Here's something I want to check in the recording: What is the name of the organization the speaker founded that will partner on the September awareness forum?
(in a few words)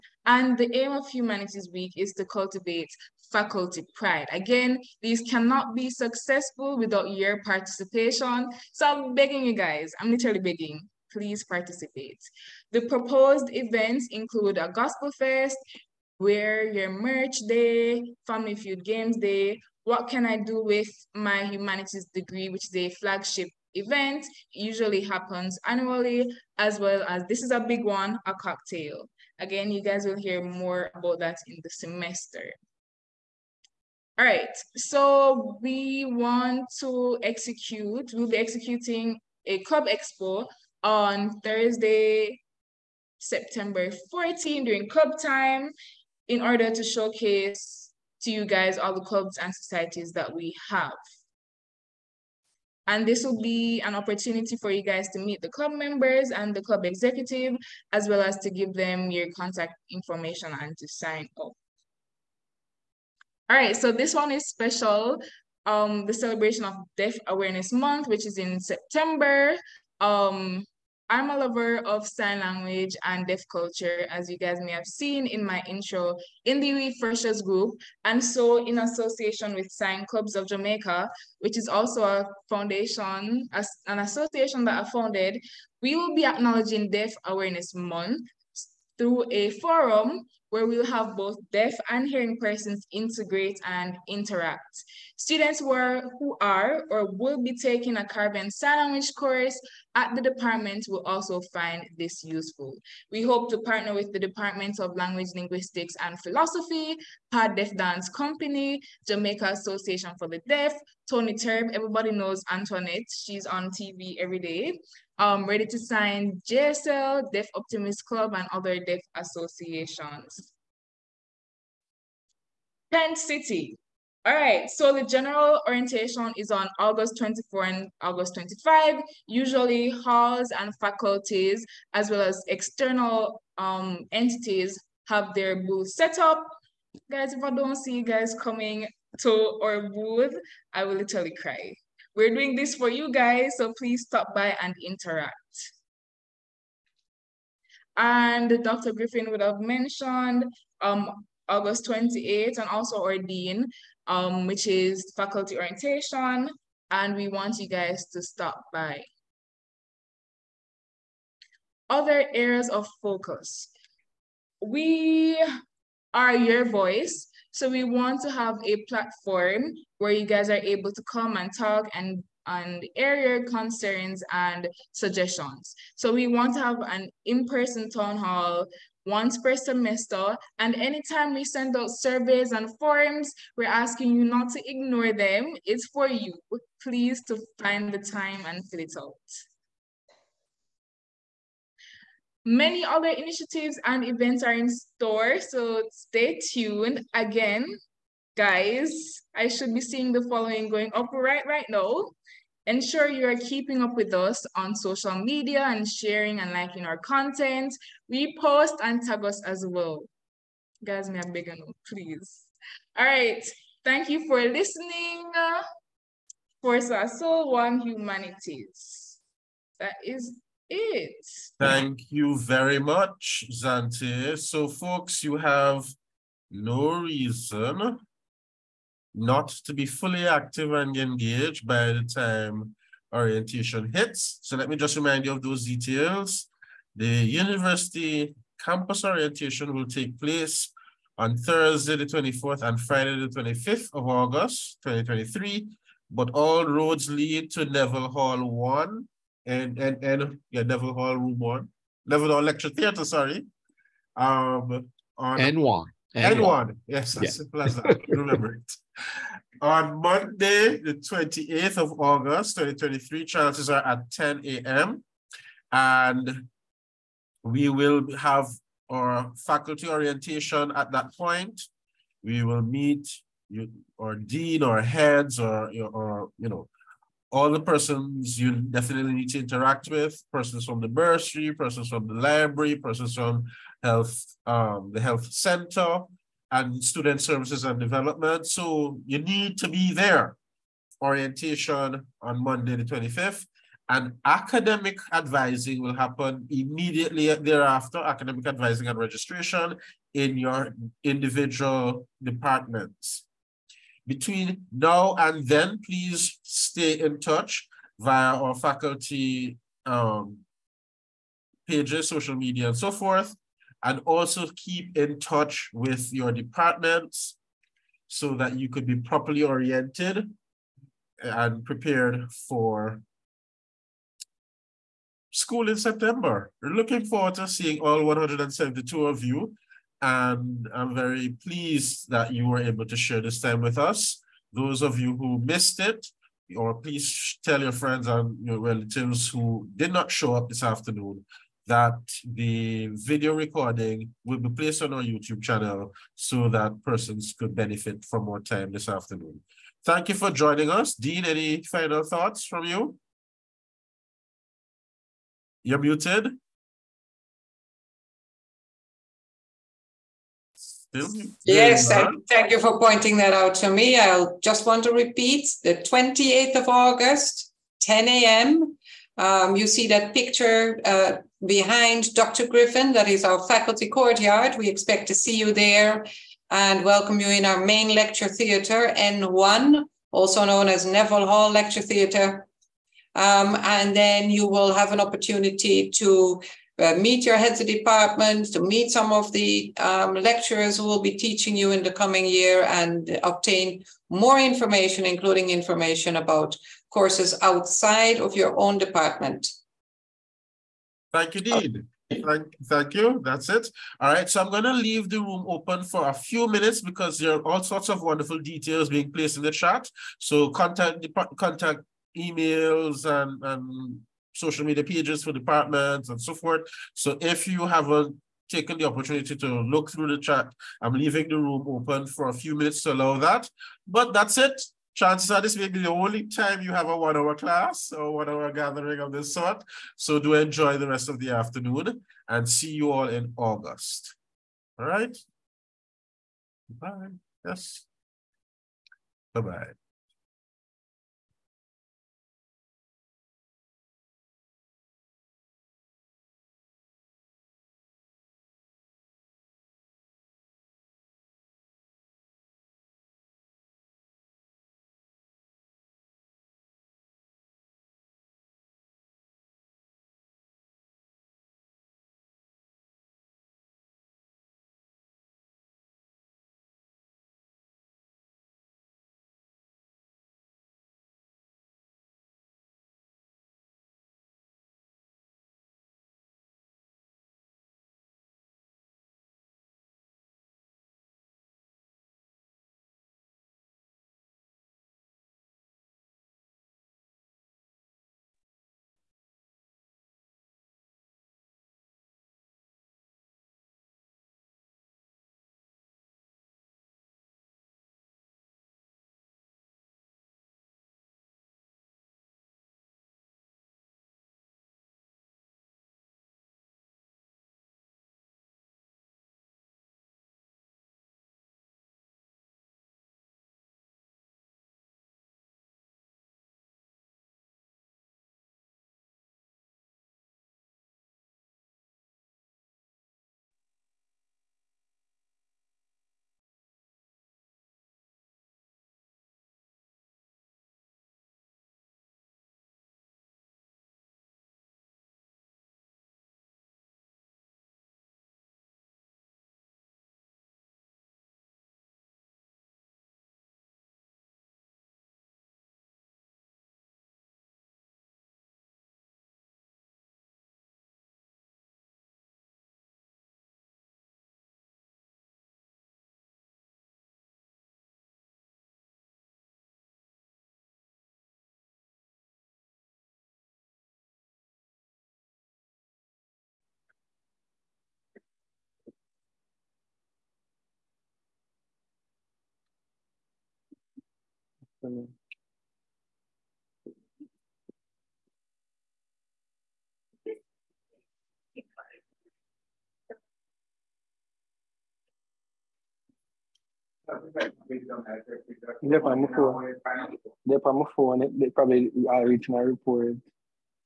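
Sign Clubs of Jamaica.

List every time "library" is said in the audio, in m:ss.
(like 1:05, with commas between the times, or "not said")
4:42.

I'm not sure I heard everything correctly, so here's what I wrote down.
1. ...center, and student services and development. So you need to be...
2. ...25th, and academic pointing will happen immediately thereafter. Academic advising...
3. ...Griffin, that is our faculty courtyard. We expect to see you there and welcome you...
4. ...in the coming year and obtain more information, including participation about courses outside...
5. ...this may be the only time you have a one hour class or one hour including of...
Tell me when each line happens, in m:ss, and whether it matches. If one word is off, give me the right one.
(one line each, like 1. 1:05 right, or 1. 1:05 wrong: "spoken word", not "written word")
1. 4:45 right
2. 4:52 wrong: "advising", not "pointing"
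3. 6:12 right
4. 6:31 wrong: "information", not "participation"
5. 7:05 wrong: "gathering", not "including".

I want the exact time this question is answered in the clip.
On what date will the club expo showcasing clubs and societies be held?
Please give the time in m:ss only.
0:41.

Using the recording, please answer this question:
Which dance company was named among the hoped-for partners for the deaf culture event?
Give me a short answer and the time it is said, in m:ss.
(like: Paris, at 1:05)
Pad Deaf Dance Company, at 1:47.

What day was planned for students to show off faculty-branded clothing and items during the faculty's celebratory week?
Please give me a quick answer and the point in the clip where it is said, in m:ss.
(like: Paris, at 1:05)
Wear your merch day, at 0:16.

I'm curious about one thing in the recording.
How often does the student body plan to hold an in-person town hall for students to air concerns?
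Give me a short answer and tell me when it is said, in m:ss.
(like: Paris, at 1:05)
Once per semester, at 2:59.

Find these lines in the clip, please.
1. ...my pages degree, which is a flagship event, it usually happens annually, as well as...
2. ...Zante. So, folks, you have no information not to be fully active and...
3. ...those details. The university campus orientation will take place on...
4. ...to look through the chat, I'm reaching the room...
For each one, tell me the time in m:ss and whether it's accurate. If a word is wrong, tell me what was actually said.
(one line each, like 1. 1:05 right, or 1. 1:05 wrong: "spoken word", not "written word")
1. 0:21 wrong: "humanities", not "pages"
2. 3:43 wrong: "reason", not "information"
3. 3:55 right
4. 6:59 wrong: "leaving", not "reaching".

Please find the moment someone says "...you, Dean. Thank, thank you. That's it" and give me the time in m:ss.
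6:41.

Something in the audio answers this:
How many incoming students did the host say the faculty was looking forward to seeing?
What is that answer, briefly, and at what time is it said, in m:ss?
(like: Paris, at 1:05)
172, at 5:28.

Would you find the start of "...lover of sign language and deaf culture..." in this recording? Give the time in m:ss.
1:11.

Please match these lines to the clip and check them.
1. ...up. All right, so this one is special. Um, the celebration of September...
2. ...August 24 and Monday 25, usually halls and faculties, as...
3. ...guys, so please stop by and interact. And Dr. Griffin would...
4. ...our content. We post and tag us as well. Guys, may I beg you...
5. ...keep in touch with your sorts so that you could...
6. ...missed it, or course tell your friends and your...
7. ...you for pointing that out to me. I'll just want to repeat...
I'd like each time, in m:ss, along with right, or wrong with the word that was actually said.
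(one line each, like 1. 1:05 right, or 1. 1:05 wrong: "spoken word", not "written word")
1. 1:01 wrong: "Deaf", not "September"
2. 2:06 wrong: "August", not "Monday"
3. 2:23 right
4. 3:26 right
5. 5:14 wrong: "departments", not "sorts"
6. 5:35 wrong: "please", not "course"
7. 6:02 right.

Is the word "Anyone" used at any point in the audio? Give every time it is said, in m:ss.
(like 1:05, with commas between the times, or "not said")
4:16.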